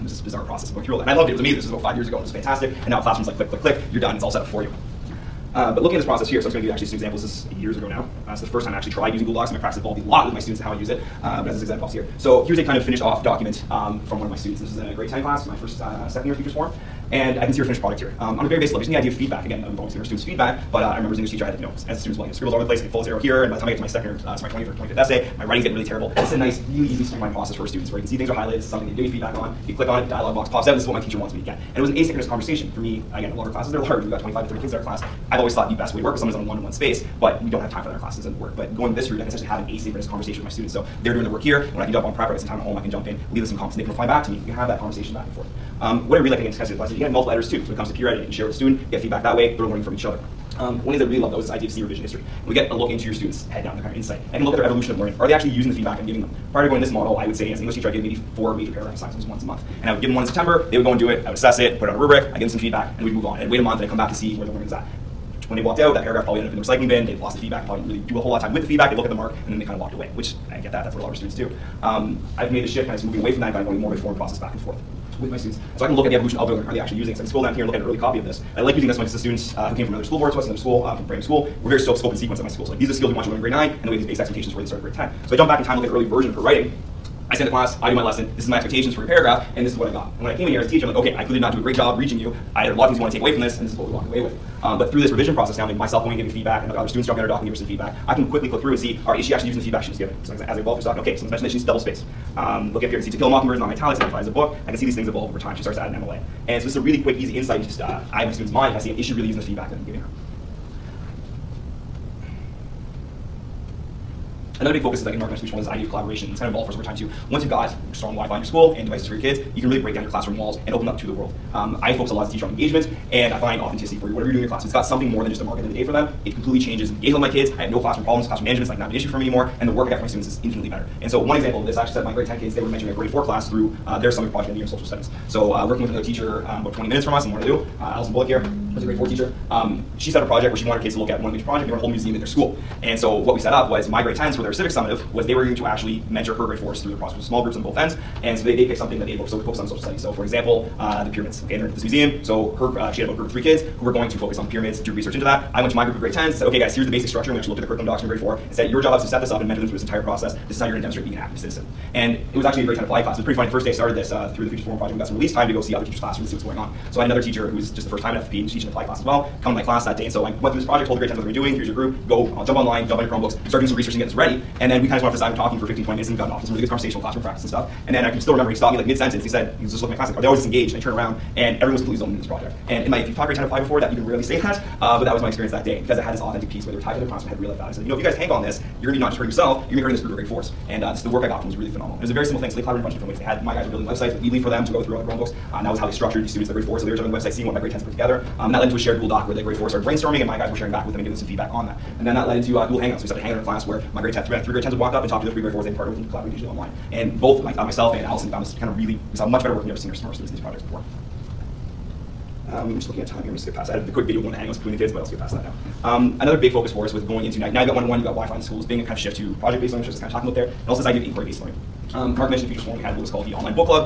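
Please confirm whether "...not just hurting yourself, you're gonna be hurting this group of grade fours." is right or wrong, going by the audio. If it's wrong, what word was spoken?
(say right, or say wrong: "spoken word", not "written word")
right.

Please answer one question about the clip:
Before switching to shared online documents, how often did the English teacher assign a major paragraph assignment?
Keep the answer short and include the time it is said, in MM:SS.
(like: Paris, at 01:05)
Once a month, at 00:59.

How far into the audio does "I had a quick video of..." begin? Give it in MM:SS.
03:33.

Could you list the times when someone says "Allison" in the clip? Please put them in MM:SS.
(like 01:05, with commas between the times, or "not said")
02:17, 03:28.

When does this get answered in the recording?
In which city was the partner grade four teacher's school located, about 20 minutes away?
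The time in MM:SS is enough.
02:17.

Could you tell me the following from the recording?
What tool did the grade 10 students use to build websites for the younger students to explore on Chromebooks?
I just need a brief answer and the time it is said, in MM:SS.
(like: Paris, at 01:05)
Weebly, at 03:14.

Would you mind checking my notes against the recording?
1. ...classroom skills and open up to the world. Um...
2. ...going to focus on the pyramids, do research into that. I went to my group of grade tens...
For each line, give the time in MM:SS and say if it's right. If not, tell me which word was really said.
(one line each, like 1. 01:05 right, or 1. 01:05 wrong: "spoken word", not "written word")
1. 02:00 wrong: "walls", not "skills"
2. 02:33 right.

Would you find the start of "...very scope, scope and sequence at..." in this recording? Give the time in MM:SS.
01:21.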